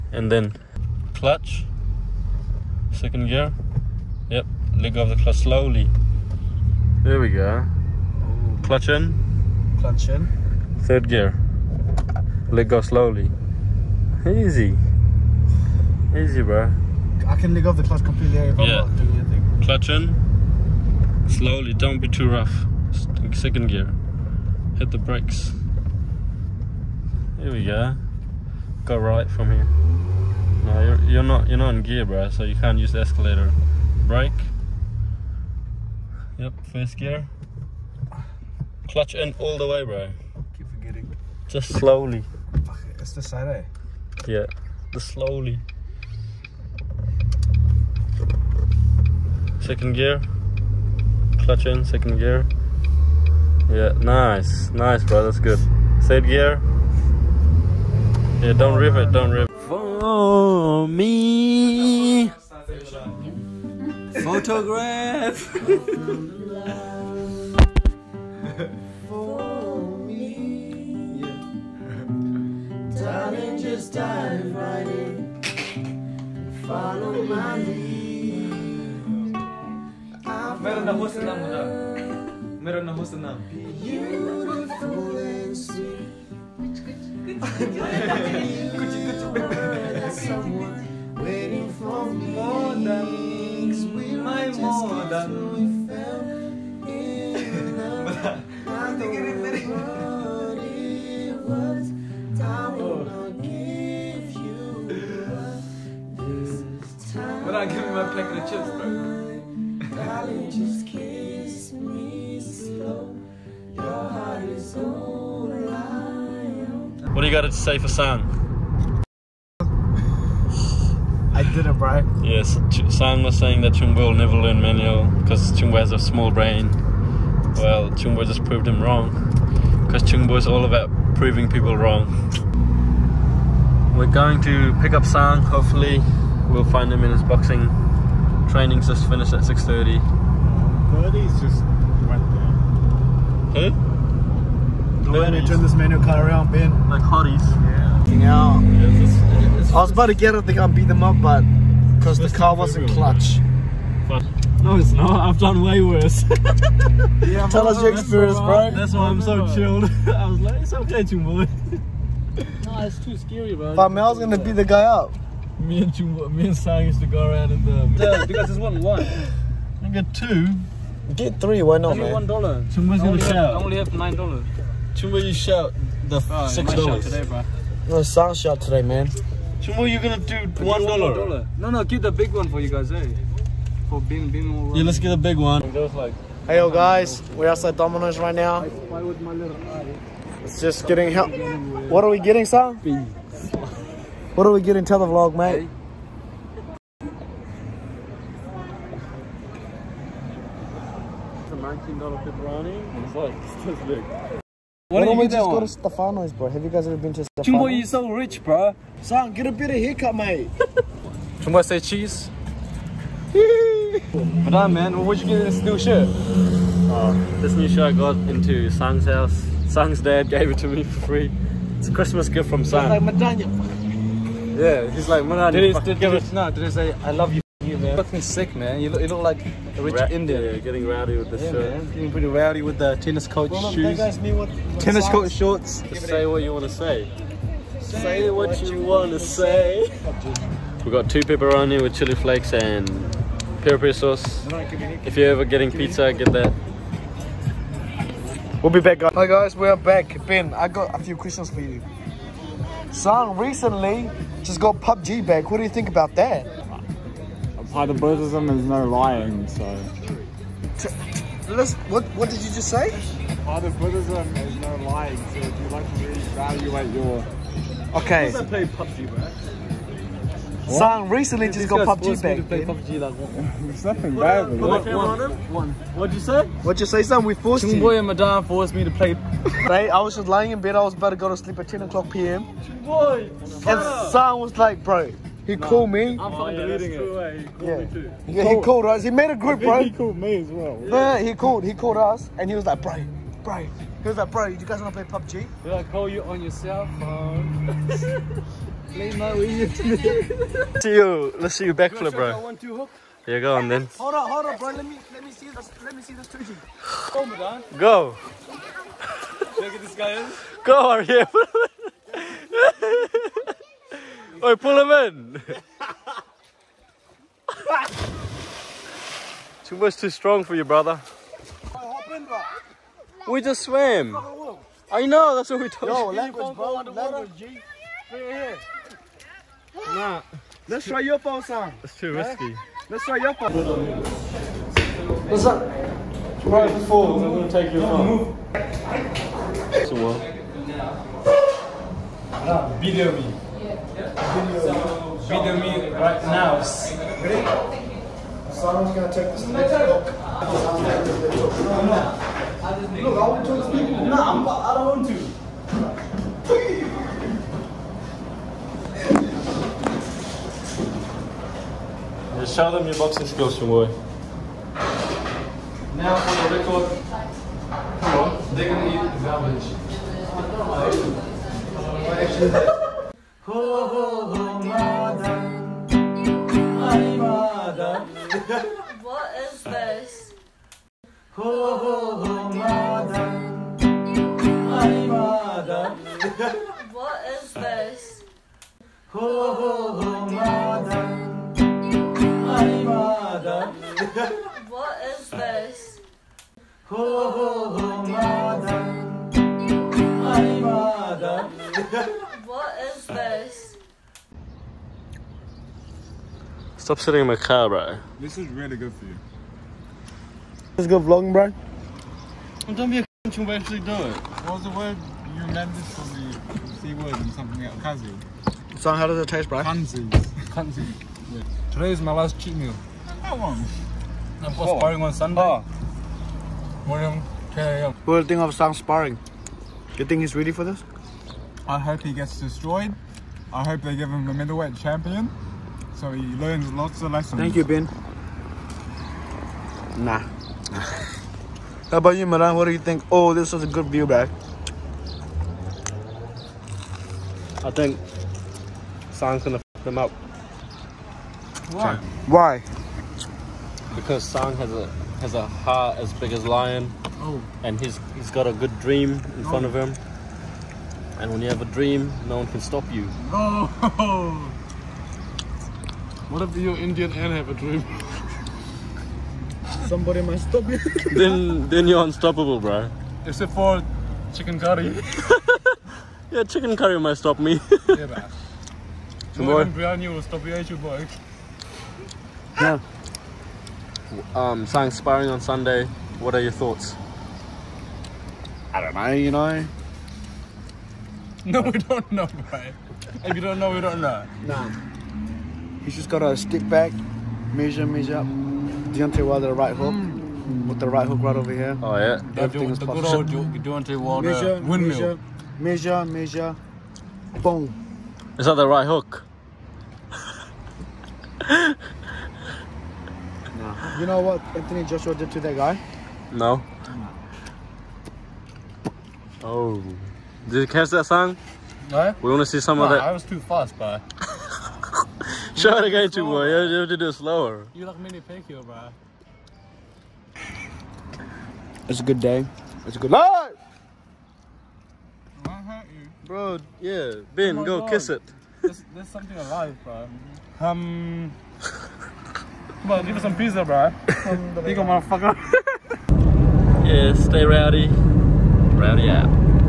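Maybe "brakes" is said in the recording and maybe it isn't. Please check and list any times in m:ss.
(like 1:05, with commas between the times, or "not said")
0:24, 0:34.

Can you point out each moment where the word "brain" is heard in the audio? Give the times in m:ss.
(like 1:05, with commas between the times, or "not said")
2:06.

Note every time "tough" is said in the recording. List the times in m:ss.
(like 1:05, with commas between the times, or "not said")
not said.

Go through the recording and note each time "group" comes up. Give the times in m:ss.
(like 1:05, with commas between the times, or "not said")
4:49.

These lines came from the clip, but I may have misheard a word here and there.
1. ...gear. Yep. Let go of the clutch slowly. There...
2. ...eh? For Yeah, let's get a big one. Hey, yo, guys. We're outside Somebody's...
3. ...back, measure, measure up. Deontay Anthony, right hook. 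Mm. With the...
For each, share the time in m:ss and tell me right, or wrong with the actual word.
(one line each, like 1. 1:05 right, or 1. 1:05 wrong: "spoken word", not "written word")
1. 0:03 right
2. 3:02 wrong: "Domino", not "Somebody"
3. 8:16 wrong: "Wilder", not "Anthony".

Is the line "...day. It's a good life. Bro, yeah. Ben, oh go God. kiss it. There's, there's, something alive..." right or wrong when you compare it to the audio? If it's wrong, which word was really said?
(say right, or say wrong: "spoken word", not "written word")
right.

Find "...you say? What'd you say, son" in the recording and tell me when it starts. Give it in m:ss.
4:36.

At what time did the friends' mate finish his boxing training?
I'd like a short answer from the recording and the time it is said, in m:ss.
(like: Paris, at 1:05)
6:30, at 2:19.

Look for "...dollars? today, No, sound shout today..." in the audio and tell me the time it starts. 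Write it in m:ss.
2:56.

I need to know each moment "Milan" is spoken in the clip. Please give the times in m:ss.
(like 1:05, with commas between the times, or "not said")
7:22.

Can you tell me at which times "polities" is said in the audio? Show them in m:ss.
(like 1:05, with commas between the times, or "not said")
not said.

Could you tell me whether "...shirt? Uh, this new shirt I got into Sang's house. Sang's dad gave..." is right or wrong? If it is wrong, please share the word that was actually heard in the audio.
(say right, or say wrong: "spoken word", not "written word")
right.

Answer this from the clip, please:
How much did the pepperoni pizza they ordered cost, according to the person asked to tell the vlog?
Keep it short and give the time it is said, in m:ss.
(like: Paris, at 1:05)
$19, at 3:21.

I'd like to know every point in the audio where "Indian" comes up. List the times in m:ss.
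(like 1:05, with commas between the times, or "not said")
3:50, 7:46.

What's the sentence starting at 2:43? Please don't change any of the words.
But Mel's gonna beat the guy up.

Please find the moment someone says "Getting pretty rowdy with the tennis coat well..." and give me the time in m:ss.
3:51.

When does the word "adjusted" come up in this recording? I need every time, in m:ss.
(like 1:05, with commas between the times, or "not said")
not said.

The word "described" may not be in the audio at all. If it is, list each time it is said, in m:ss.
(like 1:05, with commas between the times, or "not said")
not said.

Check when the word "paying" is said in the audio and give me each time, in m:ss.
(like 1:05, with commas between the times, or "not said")
not said.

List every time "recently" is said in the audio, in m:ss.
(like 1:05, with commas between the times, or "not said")
4:13, 4:31.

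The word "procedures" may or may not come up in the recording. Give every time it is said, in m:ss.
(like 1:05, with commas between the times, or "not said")
not said.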